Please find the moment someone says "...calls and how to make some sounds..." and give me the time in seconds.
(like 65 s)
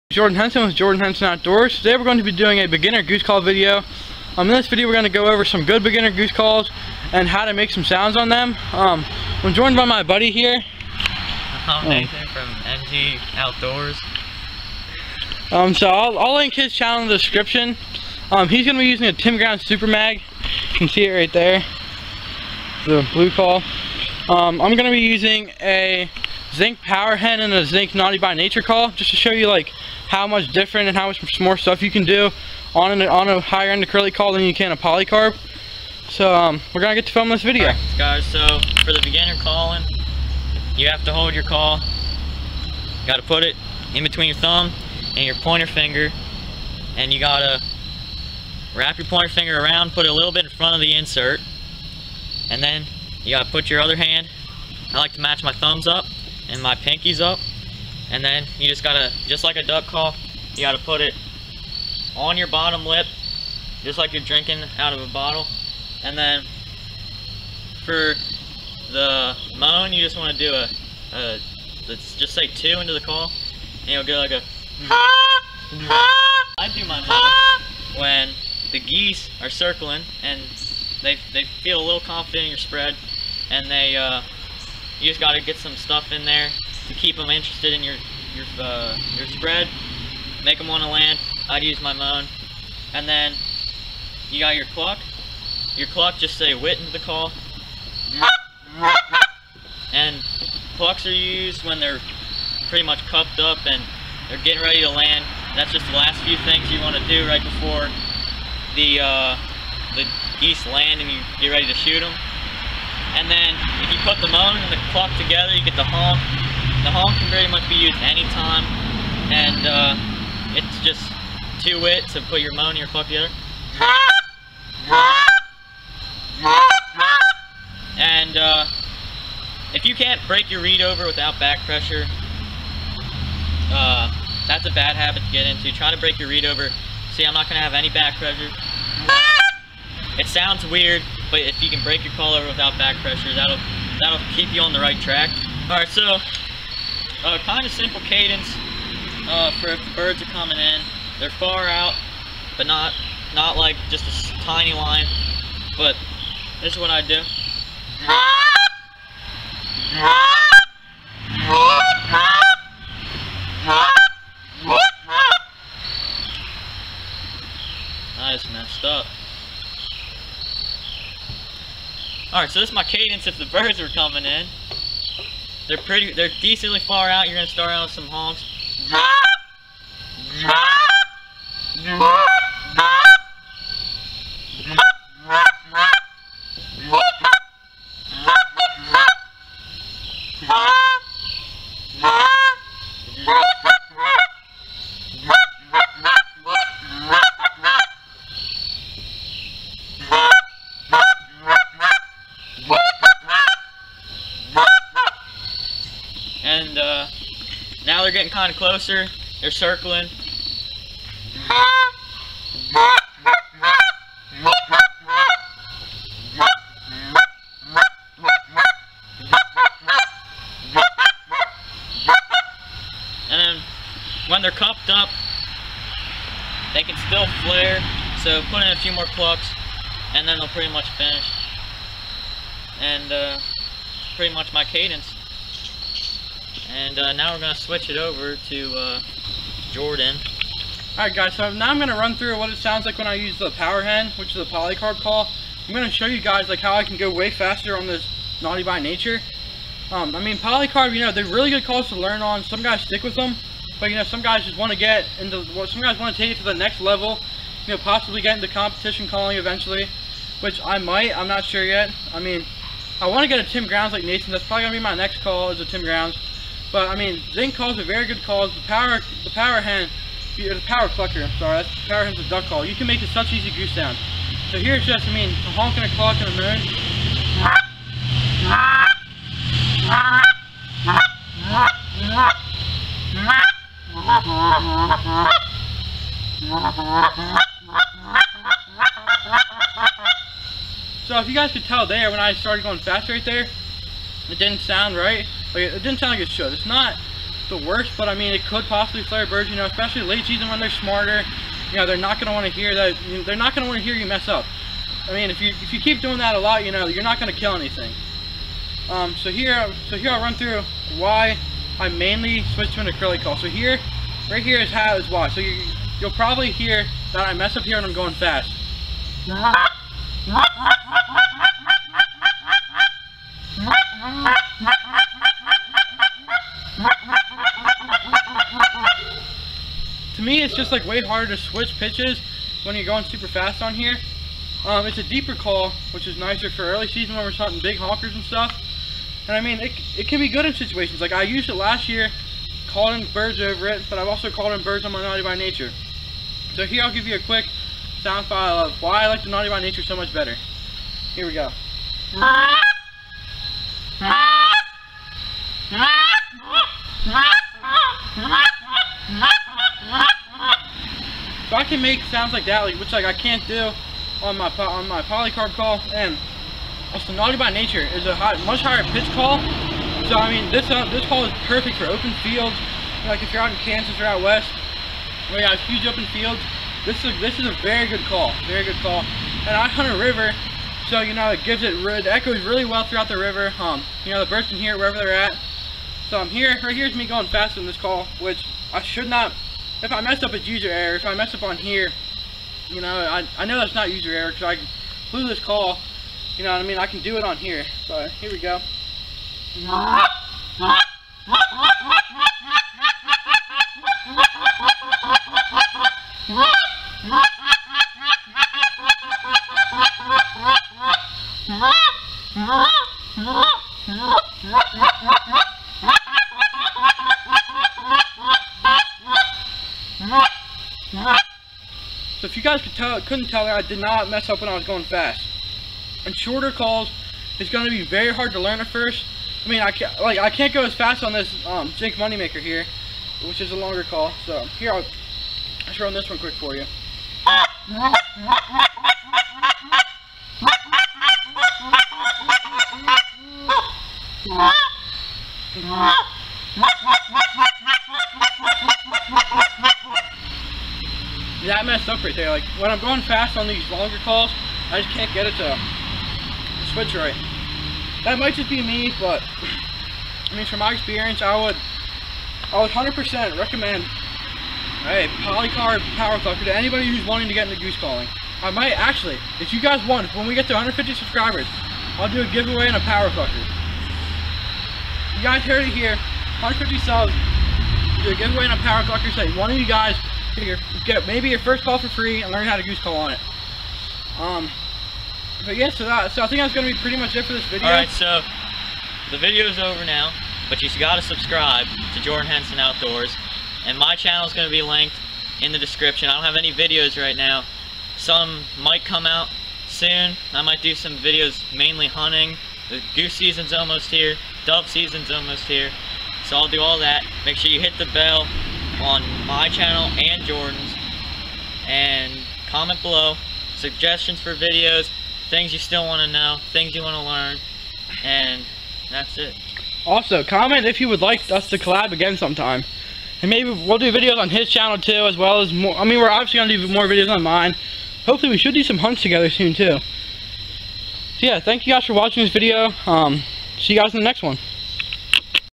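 6 s.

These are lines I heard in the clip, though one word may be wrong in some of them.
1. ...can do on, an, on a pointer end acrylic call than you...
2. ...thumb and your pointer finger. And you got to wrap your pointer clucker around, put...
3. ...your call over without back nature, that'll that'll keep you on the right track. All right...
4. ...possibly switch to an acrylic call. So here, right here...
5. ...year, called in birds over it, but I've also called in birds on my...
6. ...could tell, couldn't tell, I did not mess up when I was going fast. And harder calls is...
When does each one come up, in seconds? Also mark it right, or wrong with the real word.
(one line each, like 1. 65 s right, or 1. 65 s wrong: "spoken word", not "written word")
1. 31 s wrong: "higher", not "pointer"
2. 44 s wrong: "finger", not "clucker"
3. 142 s wrong: "pressure", not "nature"
4. 311 s wrong: "mainly", not "possibly"
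5. 341 s right
6. 422 s wrong: "shorter", not "harder".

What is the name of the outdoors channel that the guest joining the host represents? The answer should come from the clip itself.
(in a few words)
MG Outdoors.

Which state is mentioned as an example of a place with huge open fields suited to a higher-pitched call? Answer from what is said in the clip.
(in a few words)
Kansas.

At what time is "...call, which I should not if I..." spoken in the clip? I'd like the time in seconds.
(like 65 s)
387 s.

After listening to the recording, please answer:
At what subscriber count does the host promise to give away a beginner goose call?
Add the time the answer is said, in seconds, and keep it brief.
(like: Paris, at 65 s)
150, at 470 s.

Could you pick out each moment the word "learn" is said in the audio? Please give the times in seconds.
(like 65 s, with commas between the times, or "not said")
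251 s, 428 s, 482 s, 517 s.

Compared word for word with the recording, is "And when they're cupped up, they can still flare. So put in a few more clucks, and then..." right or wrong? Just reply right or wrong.
right.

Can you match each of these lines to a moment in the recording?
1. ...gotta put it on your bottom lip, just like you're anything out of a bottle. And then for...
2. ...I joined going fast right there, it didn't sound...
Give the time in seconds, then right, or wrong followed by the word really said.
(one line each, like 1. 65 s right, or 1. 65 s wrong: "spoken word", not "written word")
1. 60 s wrong: "drinking", not "anything"
2. 292 s wrong: "started", not "joined".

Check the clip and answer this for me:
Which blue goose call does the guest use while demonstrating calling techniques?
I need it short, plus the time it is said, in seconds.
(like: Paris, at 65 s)
Tim Ground Super Mag, at 19 s.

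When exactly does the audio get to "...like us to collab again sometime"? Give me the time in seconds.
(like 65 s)
521 s.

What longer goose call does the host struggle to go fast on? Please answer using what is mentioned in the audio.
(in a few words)
Jake Moneymaker.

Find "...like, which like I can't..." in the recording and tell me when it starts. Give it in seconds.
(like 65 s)
362 s.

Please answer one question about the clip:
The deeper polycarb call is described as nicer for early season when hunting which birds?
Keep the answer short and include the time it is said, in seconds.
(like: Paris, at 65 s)
big hawks, at 337 s.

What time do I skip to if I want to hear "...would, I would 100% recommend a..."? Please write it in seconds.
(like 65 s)
461 s.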